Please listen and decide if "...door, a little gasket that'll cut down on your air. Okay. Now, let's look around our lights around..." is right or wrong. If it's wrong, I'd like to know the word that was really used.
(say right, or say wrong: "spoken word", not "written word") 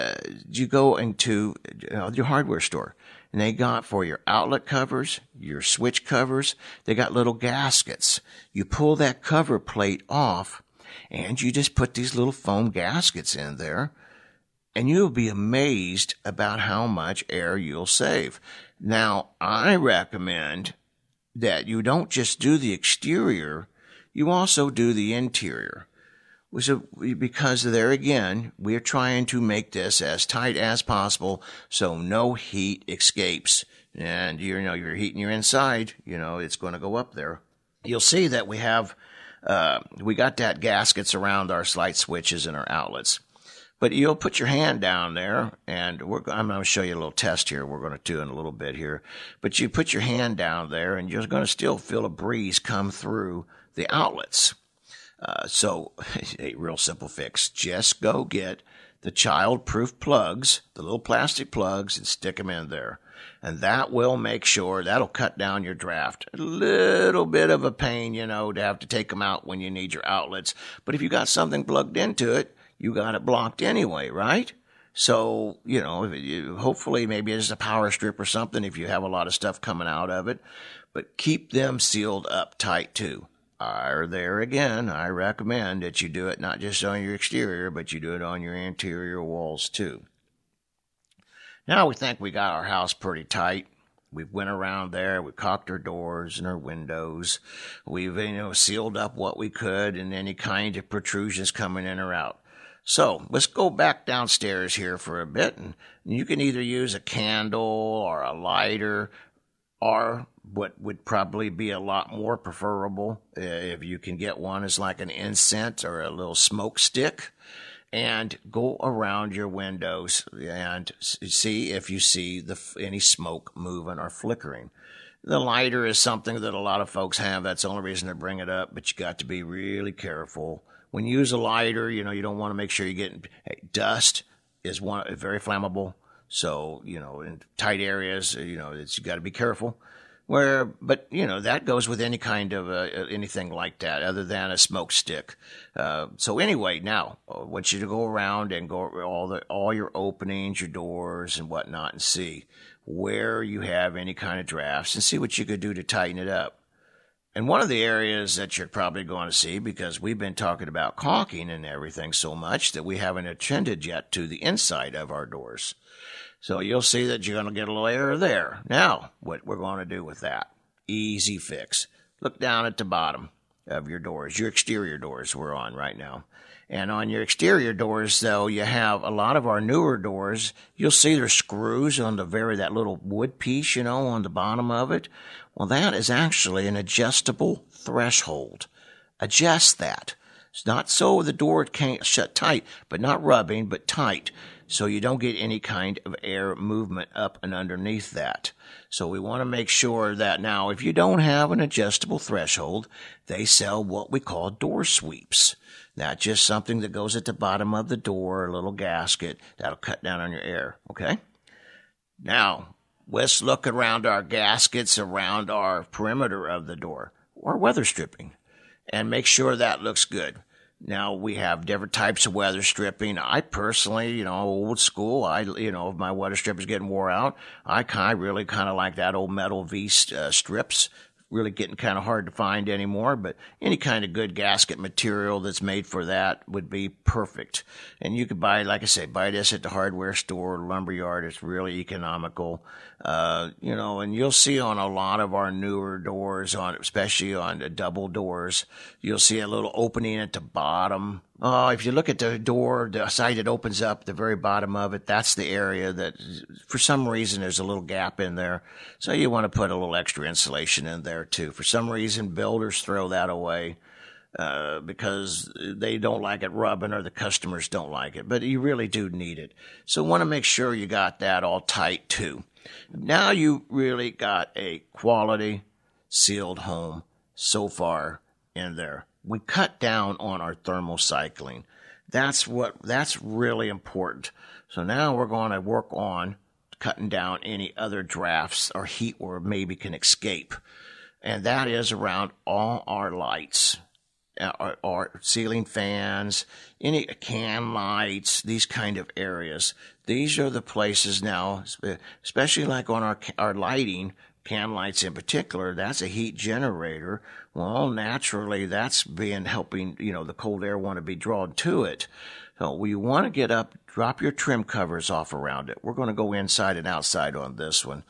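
wrong: "gaskets", not "lights".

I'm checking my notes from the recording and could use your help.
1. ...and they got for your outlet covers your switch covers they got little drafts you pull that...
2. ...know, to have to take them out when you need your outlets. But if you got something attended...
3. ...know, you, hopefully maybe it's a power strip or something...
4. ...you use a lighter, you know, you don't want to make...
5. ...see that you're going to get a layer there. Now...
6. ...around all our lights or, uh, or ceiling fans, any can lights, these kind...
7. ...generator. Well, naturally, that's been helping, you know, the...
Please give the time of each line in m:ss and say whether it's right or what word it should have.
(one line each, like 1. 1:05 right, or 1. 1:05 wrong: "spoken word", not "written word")
1. 0:03 wrong: "gaskets", not "drafts"
2. 1:08 wrong: "plugged", not "attended"
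3. 1:15 right
4. 2:11 right
5. 2:46 right
6. 4:51 right
7. 5:06 right.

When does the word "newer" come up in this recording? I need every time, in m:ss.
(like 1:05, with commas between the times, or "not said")
2:59, 4:05.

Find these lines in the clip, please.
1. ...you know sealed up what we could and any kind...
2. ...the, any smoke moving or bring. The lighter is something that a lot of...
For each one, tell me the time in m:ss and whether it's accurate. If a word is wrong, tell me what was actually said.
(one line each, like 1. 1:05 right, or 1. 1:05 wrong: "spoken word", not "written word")
1. 1:38 right
2. 2:02 wrong: "flickering", not "bring".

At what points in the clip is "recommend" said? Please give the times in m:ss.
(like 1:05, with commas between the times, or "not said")
0:19, 1:25.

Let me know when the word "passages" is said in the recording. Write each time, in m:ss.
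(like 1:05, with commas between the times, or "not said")
not said.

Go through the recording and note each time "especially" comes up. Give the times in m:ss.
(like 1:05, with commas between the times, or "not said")
4:06, 5:02.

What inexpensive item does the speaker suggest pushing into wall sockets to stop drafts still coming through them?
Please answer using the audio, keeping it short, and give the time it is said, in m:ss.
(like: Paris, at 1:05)
child-proof plugs, at 0:59.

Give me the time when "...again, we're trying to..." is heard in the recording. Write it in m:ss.
0:27.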